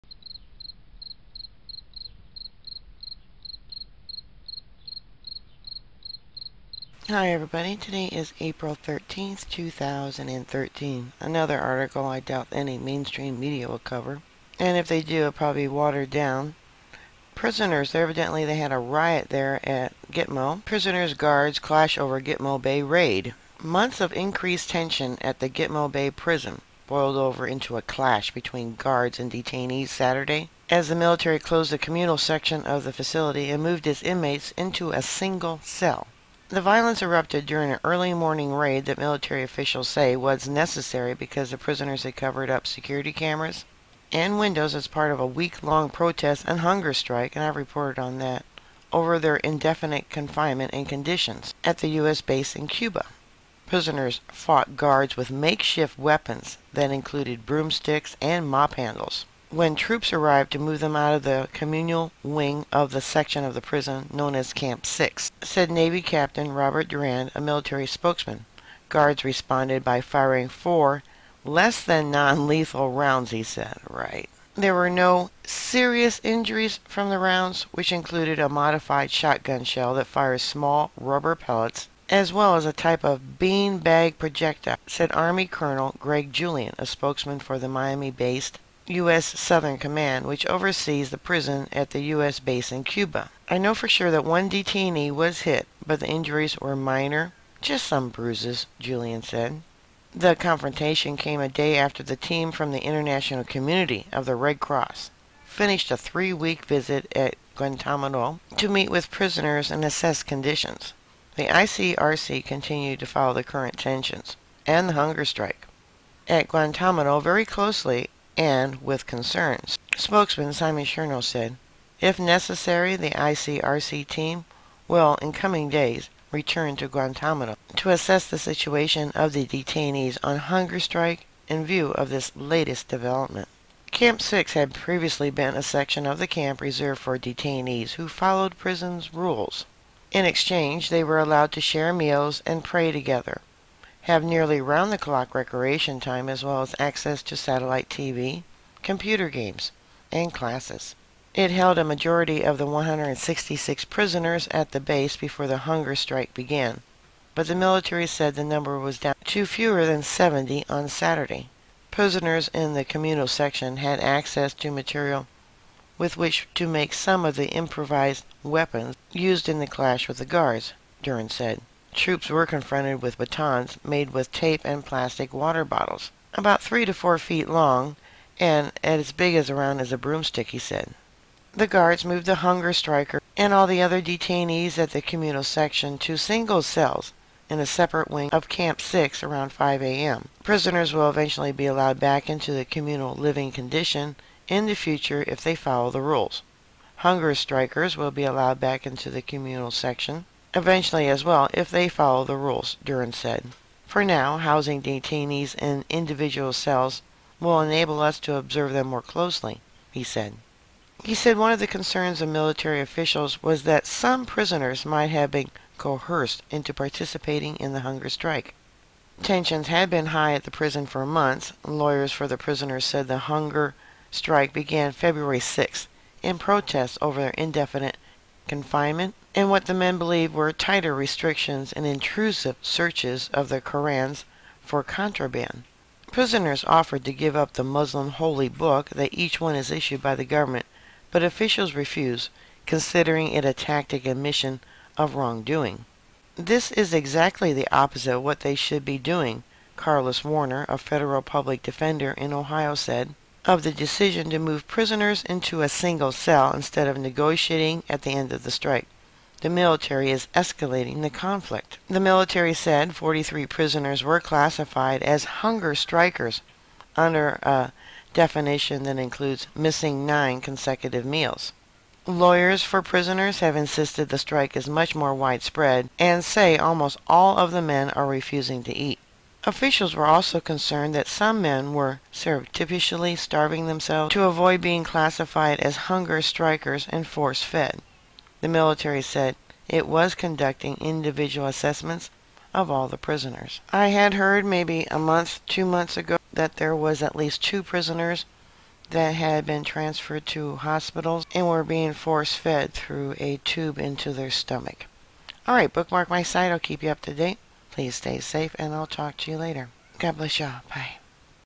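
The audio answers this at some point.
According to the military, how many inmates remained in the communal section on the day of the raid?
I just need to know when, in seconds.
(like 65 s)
159 s.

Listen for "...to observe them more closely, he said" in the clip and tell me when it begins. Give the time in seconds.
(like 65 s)
208 s.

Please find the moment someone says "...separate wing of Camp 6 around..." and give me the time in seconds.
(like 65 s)
187 s.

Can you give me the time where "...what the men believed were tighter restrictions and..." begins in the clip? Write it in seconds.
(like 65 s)
229 s.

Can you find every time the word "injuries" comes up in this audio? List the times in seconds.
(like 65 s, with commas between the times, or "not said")
76 s, 96 s.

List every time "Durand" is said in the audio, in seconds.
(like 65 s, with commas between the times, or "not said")
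66 s, 171 s, 202 s.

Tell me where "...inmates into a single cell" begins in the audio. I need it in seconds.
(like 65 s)
34 s.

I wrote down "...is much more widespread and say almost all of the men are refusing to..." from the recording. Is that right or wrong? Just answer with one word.
right.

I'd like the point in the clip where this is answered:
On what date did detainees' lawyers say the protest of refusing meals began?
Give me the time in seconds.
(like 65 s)
224 s.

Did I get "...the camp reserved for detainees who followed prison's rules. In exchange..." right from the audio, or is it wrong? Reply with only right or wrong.
right.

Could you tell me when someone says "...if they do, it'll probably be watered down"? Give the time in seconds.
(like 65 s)
14 s.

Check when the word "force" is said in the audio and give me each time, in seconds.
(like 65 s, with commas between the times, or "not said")
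287 s, 301 s.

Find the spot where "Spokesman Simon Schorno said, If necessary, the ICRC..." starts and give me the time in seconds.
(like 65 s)
119 s.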